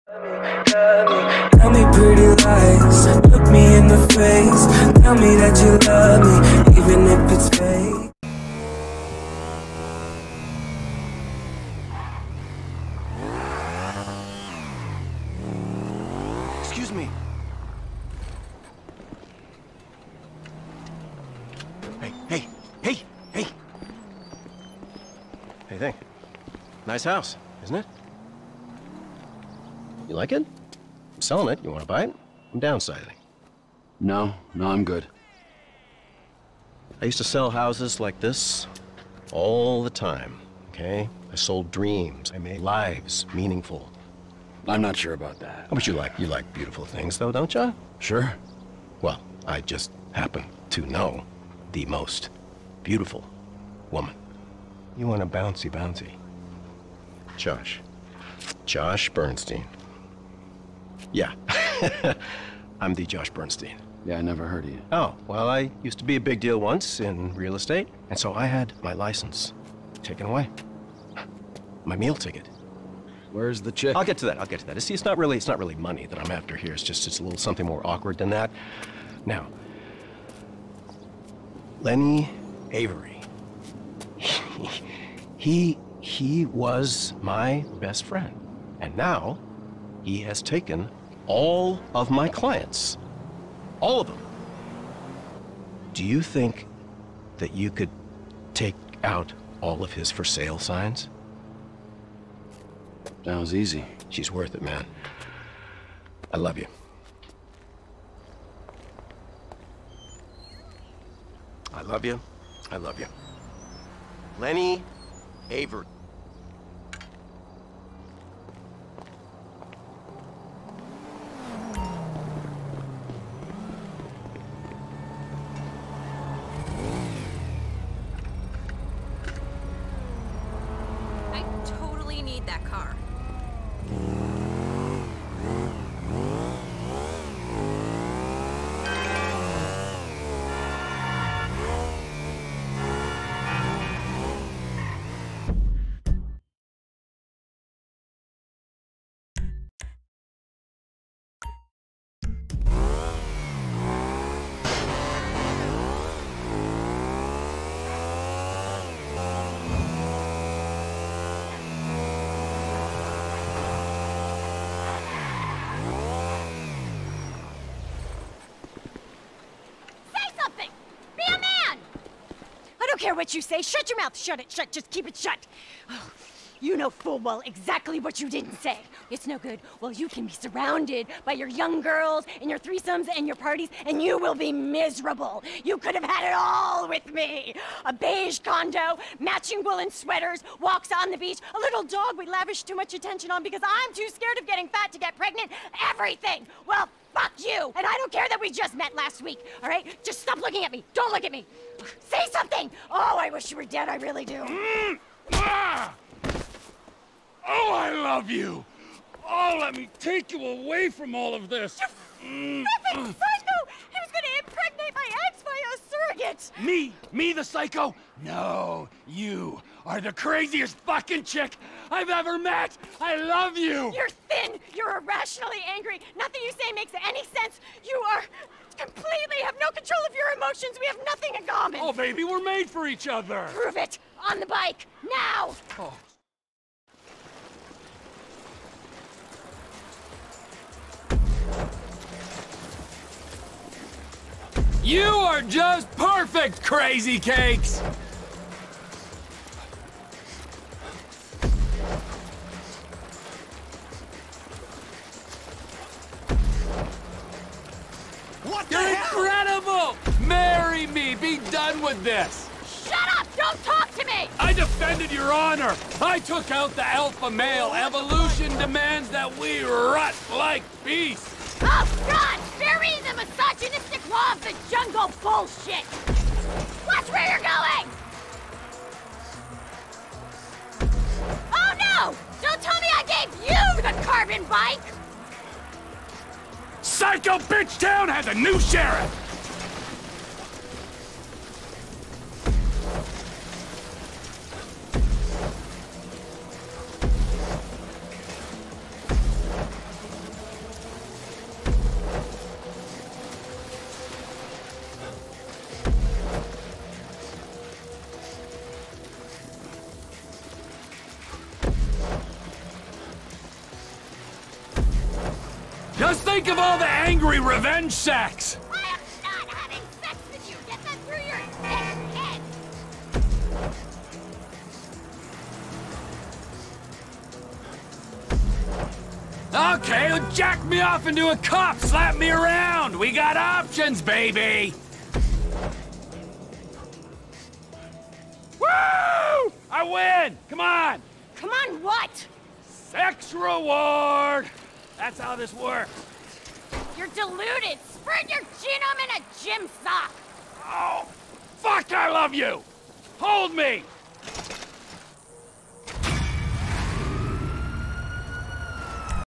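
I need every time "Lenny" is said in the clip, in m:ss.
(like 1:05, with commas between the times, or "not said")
1:21, 1:54.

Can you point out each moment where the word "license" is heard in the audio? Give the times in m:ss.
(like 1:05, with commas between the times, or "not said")
1:08.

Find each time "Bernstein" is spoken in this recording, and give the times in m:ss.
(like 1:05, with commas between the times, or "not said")
0:59, 1:03.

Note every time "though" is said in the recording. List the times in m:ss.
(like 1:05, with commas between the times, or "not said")
0:47.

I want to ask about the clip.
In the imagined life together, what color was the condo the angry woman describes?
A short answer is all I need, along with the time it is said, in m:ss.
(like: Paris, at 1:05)
Beige, at 3:07.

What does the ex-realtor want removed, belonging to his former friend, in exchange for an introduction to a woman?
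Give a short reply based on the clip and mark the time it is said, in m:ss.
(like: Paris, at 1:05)
For sale signs, at 1:40.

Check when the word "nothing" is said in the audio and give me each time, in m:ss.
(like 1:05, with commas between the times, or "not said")
3:32, 3:46, 3:51.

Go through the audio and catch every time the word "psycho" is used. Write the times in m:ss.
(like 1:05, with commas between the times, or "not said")
3:33, 3:37, 4:46.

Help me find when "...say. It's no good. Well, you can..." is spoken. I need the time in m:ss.
2:58.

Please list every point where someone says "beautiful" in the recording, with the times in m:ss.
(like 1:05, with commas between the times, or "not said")
0:46, 0:52.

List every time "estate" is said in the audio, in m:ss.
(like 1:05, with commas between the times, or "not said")
1:07.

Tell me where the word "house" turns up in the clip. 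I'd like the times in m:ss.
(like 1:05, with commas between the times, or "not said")
0:27, 0:37.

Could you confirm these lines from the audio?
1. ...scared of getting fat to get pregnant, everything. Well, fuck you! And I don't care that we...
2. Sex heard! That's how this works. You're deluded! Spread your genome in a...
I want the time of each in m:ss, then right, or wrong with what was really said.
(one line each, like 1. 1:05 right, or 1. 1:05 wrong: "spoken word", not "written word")
1. 3:14 right
2. 5:42 wrong: "reward", not "heard".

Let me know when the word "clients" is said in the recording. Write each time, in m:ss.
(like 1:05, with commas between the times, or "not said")
1:32.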